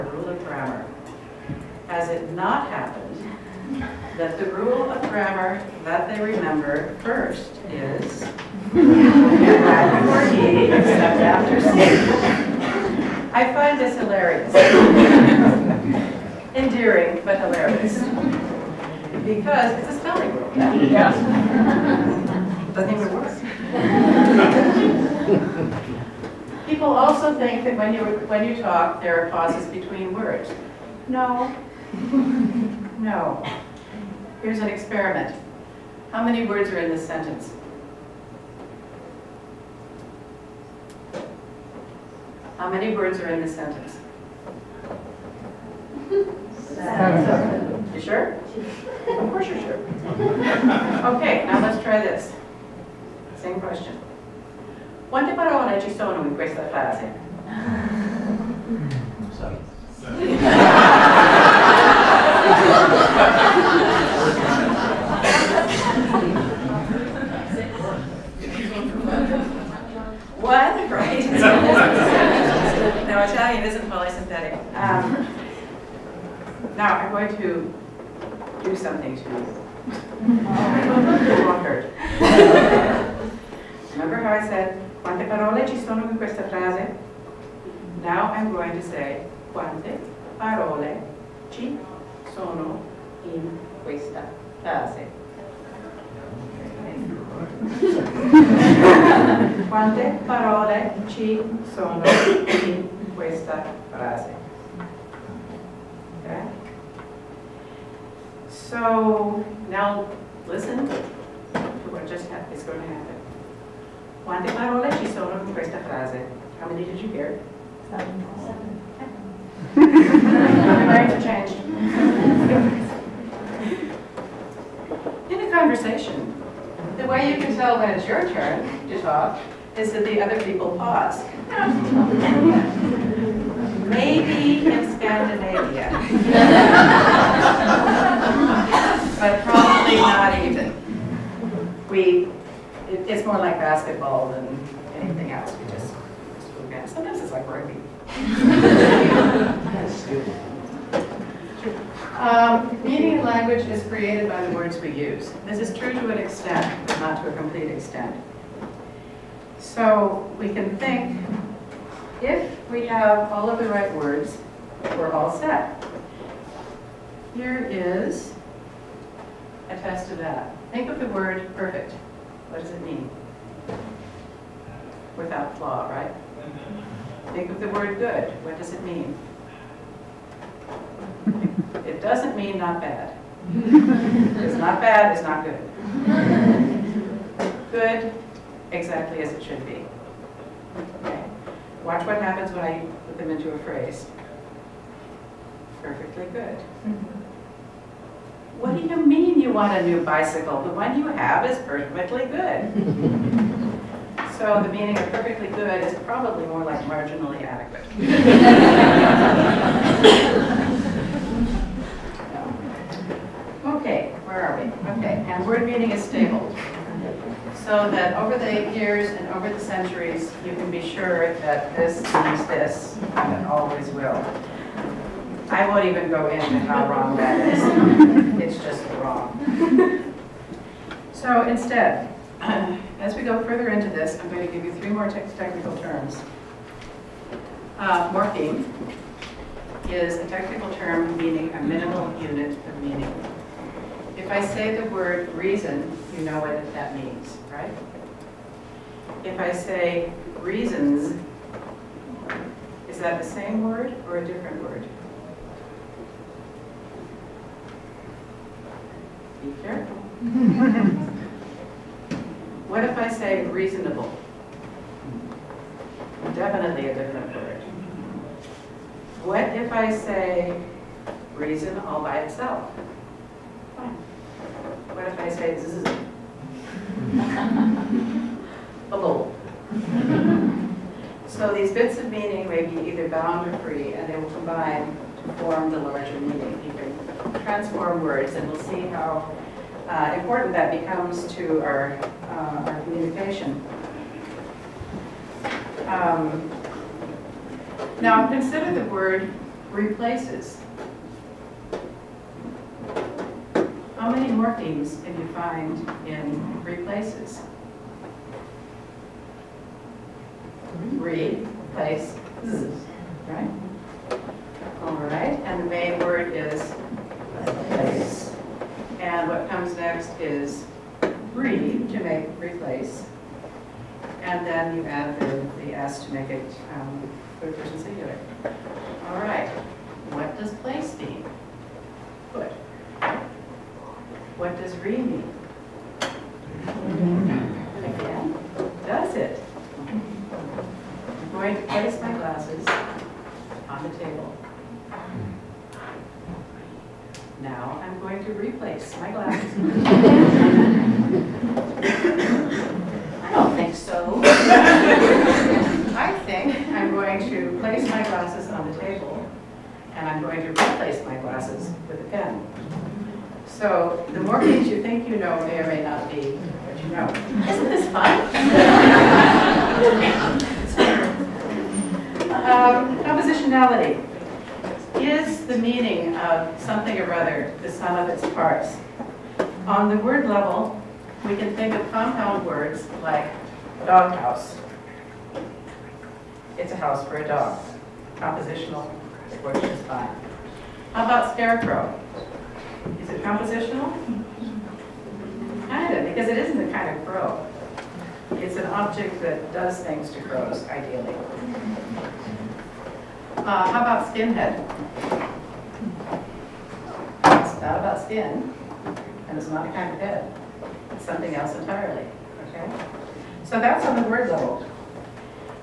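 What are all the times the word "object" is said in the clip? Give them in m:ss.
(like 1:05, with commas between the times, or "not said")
6:38.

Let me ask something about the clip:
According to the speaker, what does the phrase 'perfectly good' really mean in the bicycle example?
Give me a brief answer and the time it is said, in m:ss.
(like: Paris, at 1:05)
marginally adequate, at 3:26.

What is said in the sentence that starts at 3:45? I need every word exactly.
I won't even go into how wrong that is.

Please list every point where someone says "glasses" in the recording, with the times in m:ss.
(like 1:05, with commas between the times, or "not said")
5:42, 5:49.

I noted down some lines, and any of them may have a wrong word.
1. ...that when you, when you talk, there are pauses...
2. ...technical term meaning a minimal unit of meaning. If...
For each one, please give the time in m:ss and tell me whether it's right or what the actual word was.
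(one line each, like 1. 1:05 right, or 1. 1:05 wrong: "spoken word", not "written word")
1. 0:27 right
2. 4:00 right.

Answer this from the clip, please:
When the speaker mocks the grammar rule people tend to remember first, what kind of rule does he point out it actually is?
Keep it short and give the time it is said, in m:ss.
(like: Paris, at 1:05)
spelling rule, at 0:19.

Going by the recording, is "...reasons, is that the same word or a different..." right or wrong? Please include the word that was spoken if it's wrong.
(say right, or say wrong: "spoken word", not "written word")
right.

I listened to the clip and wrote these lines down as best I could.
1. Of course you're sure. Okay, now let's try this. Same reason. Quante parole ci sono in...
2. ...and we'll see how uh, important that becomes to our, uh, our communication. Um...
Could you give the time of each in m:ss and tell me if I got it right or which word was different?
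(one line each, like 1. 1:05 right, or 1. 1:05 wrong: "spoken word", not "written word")
1. 0:49 wrong: "question", not "reason"
2. 4:48 right.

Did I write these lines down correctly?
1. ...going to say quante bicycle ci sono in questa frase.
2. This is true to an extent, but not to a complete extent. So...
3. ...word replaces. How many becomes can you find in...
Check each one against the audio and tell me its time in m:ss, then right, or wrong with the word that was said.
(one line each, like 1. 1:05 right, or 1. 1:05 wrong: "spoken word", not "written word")
1. 1:28 wrong: "parole", not "bicycle"
2. 2:35 right
3. 4:58 wrong: "morphemes", not "becomes".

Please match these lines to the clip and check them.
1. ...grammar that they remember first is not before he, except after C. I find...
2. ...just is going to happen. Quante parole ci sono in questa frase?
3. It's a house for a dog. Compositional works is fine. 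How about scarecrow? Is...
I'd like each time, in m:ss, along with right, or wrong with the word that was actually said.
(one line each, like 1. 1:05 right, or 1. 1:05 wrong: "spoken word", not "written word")
1. 0:05 right
2. 1:52 right
3. 6:26 right.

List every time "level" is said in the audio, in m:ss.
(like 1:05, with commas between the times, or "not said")
6:20, 6:54.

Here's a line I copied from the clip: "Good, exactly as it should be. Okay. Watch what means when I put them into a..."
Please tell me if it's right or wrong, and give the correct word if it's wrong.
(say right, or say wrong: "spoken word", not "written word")
wrong: "happens", not "means".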